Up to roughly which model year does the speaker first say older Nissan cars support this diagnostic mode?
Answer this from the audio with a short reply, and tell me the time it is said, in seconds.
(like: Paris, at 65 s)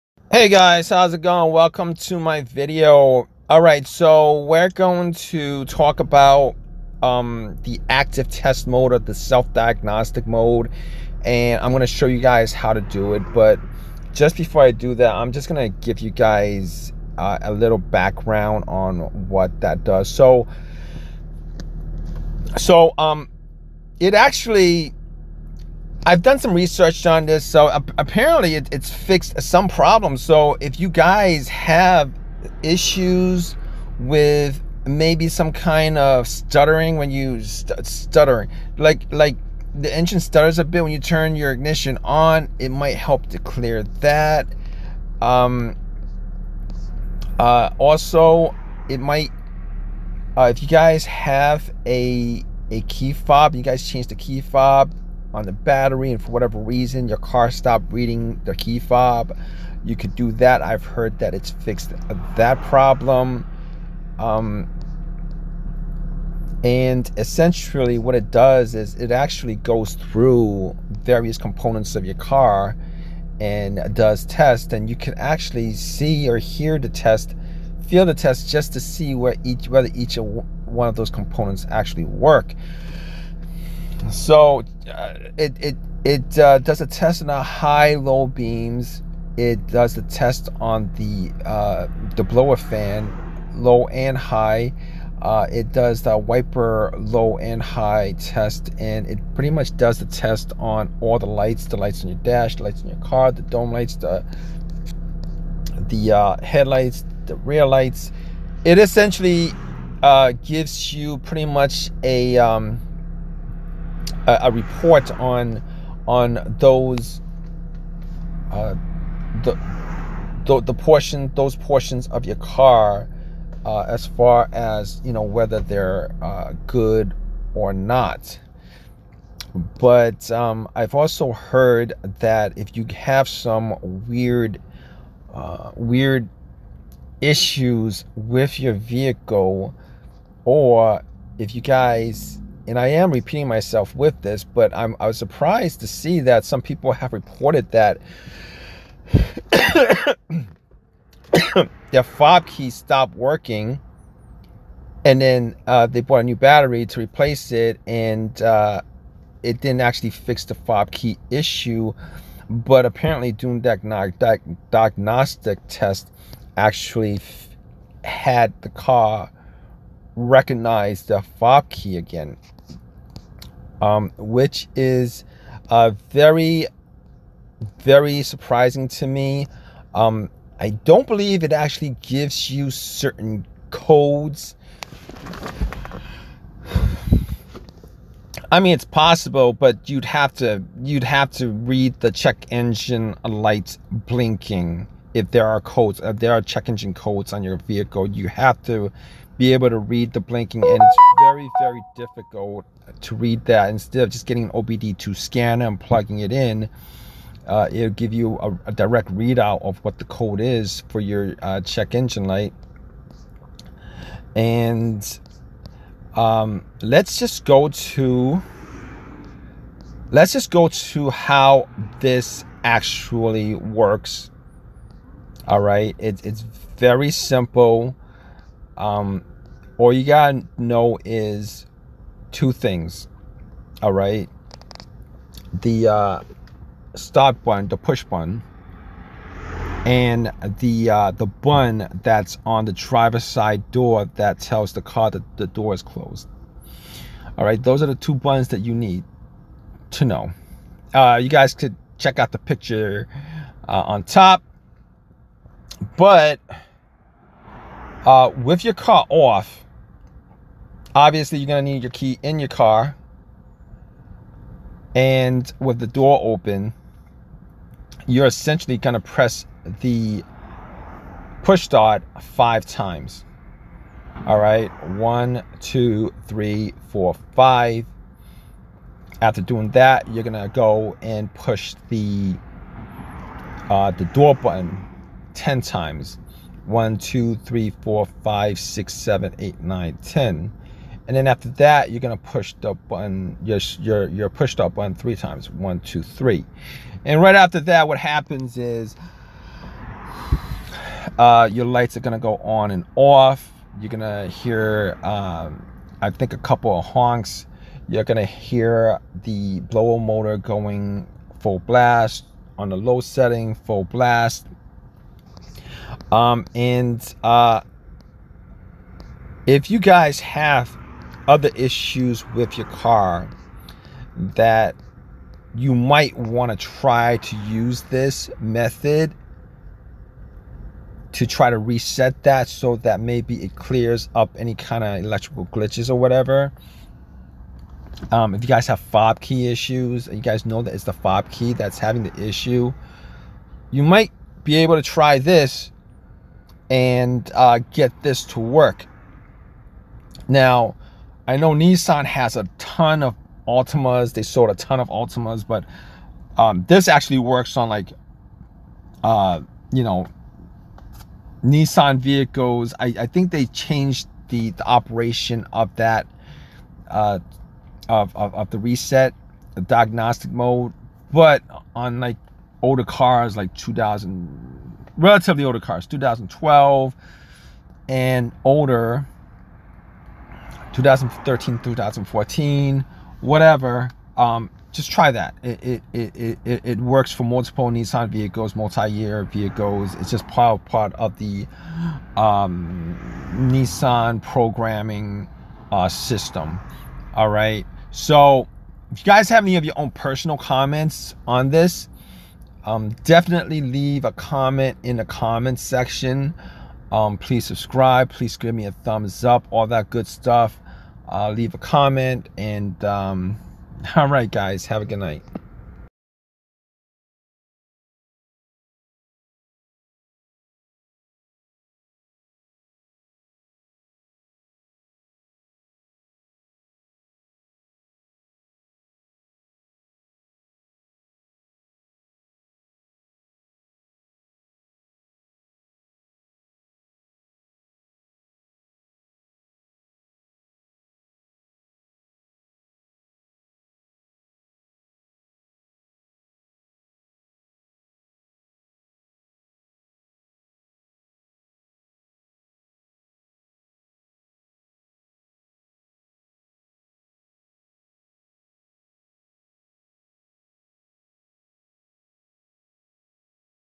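2012, at 375 s.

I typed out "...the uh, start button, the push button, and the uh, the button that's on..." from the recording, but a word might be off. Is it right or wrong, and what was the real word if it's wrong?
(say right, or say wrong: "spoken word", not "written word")
right.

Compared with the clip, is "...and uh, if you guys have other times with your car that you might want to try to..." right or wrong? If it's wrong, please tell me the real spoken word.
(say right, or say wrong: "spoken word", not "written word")
wrong: "issues", not "times".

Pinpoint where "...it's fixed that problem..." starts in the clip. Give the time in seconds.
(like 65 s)
61 s.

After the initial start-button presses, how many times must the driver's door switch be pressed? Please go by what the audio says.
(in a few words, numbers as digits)
10.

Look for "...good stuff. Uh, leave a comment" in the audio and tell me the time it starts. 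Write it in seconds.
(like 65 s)
409 s.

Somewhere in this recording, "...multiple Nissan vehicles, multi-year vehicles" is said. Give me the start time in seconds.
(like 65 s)
387 s.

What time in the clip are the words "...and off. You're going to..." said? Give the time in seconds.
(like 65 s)
302 s.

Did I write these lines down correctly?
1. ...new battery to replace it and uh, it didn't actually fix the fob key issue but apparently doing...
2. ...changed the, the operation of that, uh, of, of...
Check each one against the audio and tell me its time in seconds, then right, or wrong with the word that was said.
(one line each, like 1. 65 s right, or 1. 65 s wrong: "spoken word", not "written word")
1. 156 s right
2. 363 s right.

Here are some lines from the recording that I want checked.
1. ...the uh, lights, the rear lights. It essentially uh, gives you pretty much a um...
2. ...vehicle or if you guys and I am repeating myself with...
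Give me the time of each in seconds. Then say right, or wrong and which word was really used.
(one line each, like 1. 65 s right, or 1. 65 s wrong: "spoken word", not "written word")
1. 105 s wrong: "headlights", not "lights"
2. 138 s right.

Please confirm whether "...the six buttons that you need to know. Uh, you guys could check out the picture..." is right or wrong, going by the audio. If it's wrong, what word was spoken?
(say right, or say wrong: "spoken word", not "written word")
wrong: "two", not "six".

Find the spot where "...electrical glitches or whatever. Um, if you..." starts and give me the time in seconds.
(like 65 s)
335 s.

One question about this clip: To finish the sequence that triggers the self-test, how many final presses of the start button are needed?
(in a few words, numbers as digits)
3.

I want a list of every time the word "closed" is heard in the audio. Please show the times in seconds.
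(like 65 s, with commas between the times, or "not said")
245 s.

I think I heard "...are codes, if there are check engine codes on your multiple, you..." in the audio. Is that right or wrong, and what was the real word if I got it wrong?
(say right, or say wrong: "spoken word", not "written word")
wrong: "vehicle", not "multiple".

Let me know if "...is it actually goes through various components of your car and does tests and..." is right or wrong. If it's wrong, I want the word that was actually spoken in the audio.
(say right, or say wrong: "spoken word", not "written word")
right.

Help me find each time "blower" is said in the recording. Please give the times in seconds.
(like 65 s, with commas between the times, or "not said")
92 s, 309 s.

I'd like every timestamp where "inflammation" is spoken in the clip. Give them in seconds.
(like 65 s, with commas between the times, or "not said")
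not said.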